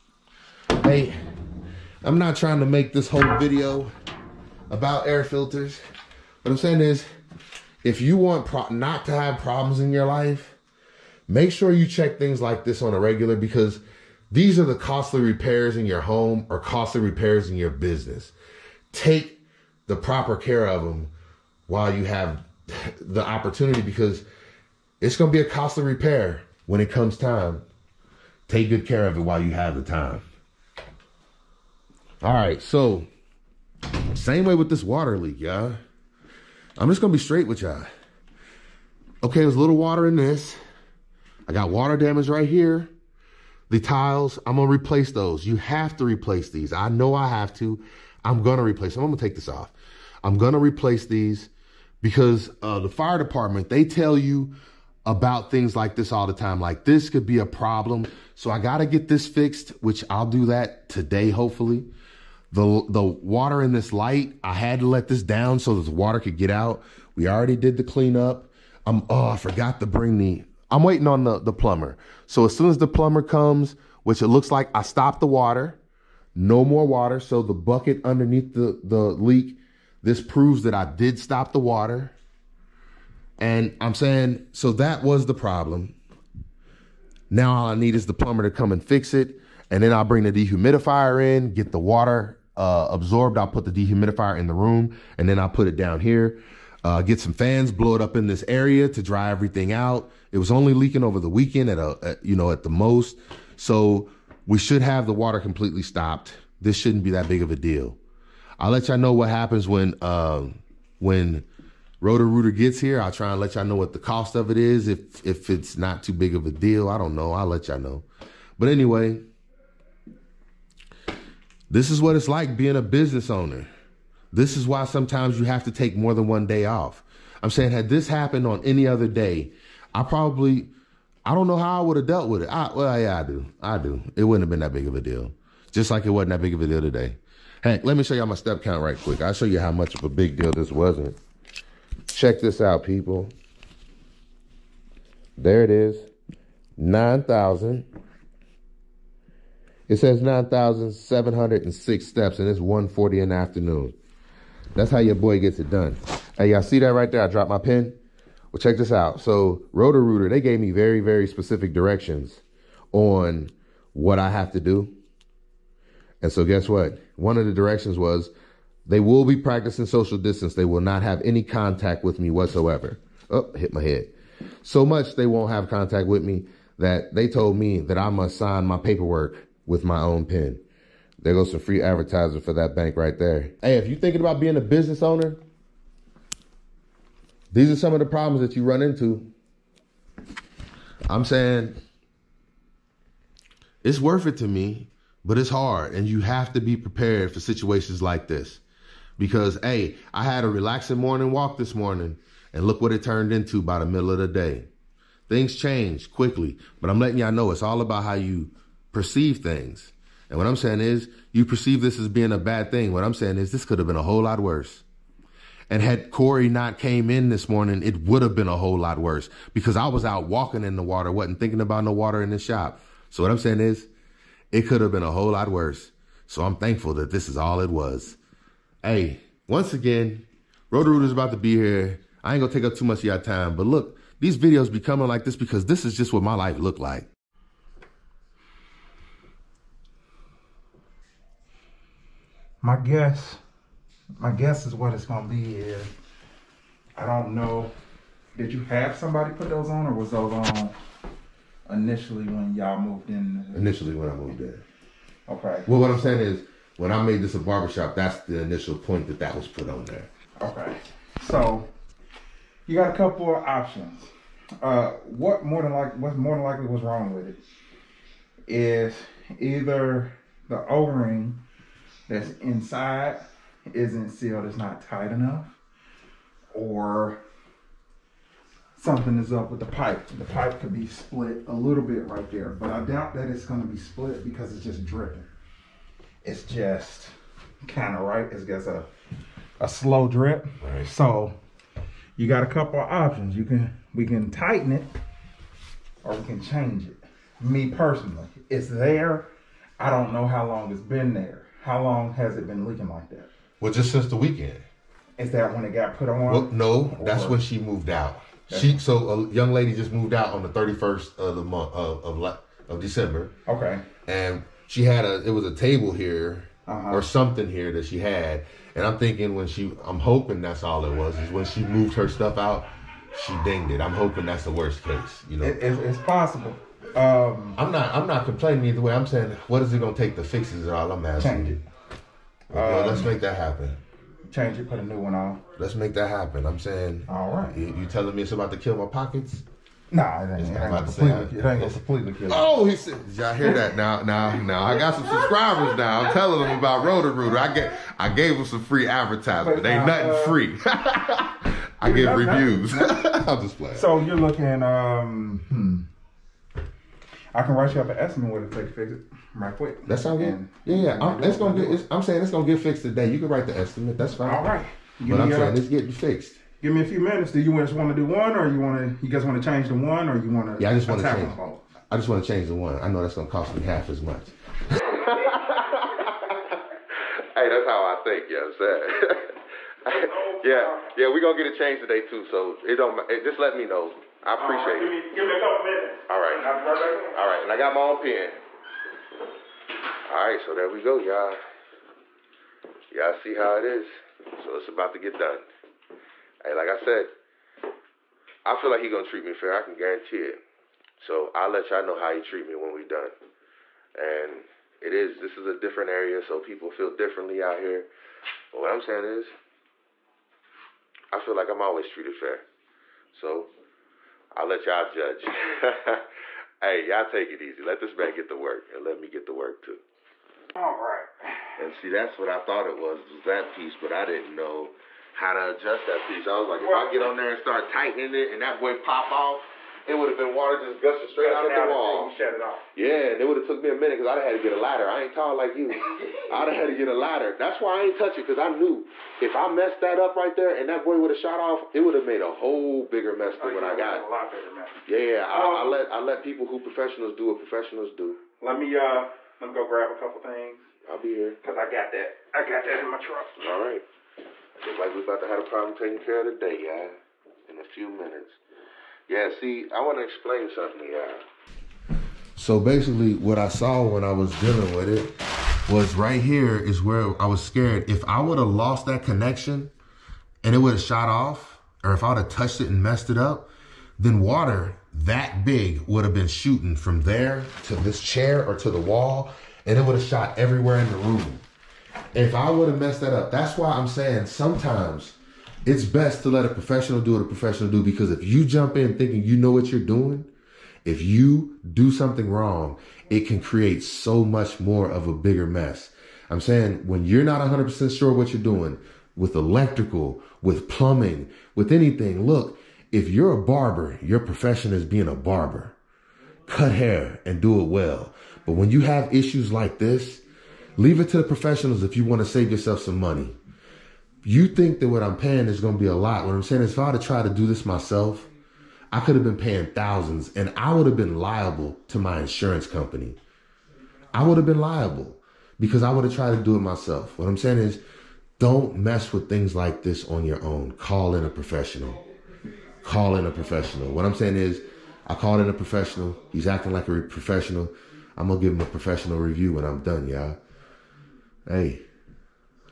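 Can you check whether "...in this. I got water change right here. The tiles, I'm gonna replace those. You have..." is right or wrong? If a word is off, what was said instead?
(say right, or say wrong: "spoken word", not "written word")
wrong: "damage", not "change".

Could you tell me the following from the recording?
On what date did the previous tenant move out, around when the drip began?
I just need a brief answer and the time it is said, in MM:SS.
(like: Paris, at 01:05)
December 31, at 05:10.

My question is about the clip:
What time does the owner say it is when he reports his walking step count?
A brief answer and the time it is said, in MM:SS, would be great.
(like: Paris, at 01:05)
1:40, at 02:32.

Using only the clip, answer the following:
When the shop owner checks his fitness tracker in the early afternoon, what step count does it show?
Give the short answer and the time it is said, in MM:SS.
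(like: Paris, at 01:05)
9,706, at 02:30.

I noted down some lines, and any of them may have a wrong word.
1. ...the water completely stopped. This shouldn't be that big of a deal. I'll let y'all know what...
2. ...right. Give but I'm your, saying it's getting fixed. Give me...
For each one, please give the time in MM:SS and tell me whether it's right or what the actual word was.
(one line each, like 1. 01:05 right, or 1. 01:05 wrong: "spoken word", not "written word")
1. 01:45 right
2. 06:04 right.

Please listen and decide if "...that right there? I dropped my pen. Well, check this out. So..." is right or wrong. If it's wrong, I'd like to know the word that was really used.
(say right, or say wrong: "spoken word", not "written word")
right.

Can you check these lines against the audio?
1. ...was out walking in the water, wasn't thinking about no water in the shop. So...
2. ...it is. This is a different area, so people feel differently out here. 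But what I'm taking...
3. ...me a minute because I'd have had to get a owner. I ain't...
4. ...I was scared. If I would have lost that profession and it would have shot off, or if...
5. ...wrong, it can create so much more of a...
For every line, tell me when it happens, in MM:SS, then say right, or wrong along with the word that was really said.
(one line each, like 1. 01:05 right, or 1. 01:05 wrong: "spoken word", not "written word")
1. 03:39 right
2. 06:44 wrong: "saying", not "taking"
3. 07:13 wrong: "ladder", not "owner"
4. 07:47 wrong: "connection", not "profession"
5. 08:12 right.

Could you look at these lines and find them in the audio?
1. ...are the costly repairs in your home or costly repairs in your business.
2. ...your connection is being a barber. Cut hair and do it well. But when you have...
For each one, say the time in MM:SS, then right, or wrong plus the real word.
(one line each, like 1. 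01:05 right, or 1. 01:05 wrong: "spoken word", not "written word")
1. 00:14 right
2. 08:24 wrong: "profession", not "connection".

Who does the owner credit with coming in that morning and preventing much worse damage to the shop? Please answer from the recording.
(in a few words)
Corey.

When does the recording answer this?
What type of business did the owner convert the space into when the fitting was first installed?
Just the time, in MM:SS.
04:17.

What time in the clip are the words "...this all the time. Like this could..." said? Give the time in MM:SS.
00:55.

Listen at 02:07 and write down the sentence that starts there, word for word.
I'm saying, had this happened on any other day, I probably, I don't know how I would have dealt with it.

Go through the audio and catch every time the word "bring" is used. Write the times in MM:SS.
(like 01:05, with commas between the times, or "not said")
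01:09, 01:30.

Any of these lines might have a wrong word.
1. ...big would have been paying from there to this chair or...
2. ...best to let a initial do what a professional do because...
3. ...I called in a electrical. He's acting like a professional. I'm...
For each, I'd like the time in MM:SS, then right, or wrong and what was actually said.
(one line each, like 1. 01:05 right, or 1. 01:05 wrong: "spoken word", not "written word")
1. 07:55 wrong: "shooting", not "paying"
2. 08:05 wrong: "professional", not "initial"
3. 08:55 wrong: "professional", not "electrical".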